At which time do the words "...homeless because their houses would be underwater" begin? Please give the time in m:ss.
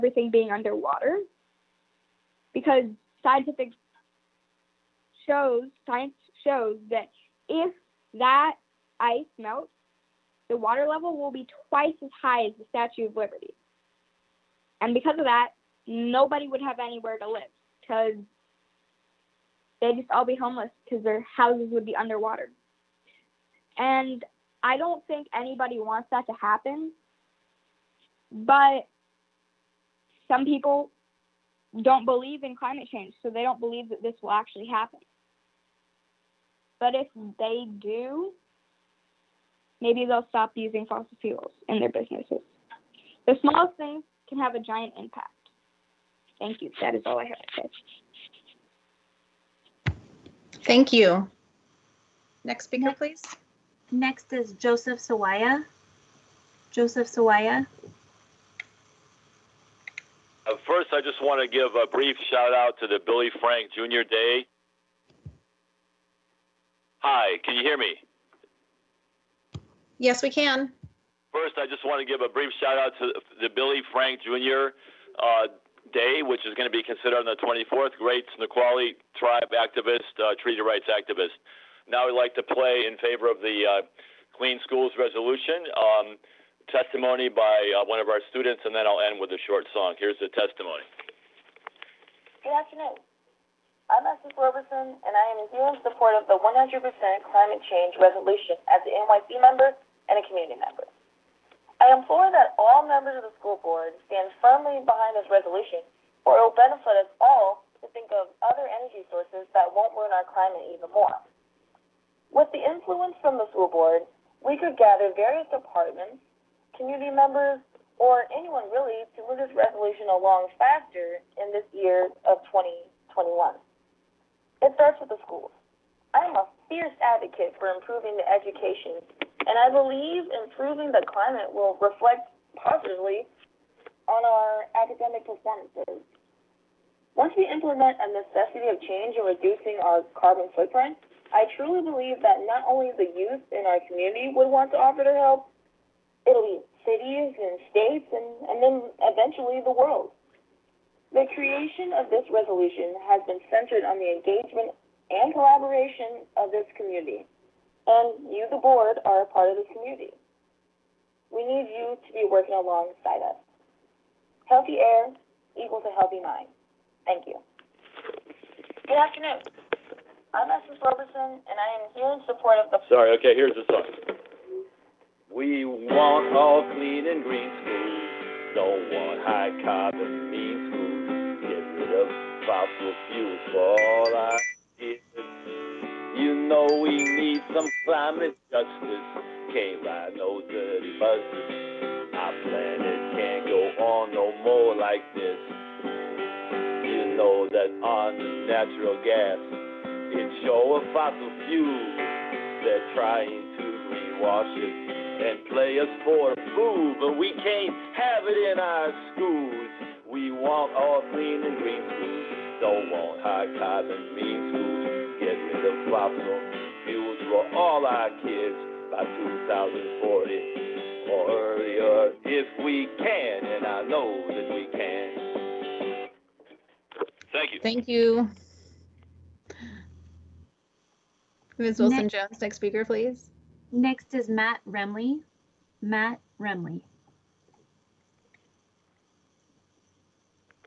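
0:20.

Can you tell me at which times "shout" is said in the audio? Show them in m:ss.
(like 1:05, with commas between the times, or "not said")
1:02, 1:12.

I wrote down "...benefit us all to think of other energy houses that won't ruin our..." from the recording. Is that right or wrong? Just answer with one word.
wrong.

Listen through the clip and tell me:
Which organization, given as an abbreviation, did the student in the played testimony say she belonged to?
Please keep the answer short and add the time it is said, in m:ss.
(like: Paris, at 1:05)
NYC, at 1:38.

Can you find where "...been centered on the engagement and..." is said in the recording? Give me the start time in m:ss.
2:33.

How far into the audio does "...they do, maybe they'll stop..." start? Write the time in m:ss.
0:37.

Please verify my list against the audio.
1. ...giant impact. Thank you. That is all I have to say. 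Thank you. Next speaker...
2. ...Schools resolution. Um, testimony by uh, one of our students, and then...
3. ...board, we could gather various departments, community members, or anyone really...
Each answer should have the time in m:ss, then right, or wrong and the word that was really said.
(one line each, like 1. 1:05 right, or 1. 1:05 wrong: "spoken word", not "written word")
1. 0:44 right
2. 1:24 right
3. 1:53 right.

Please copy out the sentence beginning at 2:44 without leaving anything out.
Healthy air equals a healthy mind.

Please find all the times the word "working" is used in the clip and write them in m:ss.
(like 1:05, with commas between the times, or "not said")
2:42.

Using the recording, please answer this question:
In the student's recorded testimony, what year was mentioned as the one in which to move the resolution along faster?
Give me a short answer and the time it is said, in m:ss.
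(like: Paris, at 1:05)
2021, at 2:02.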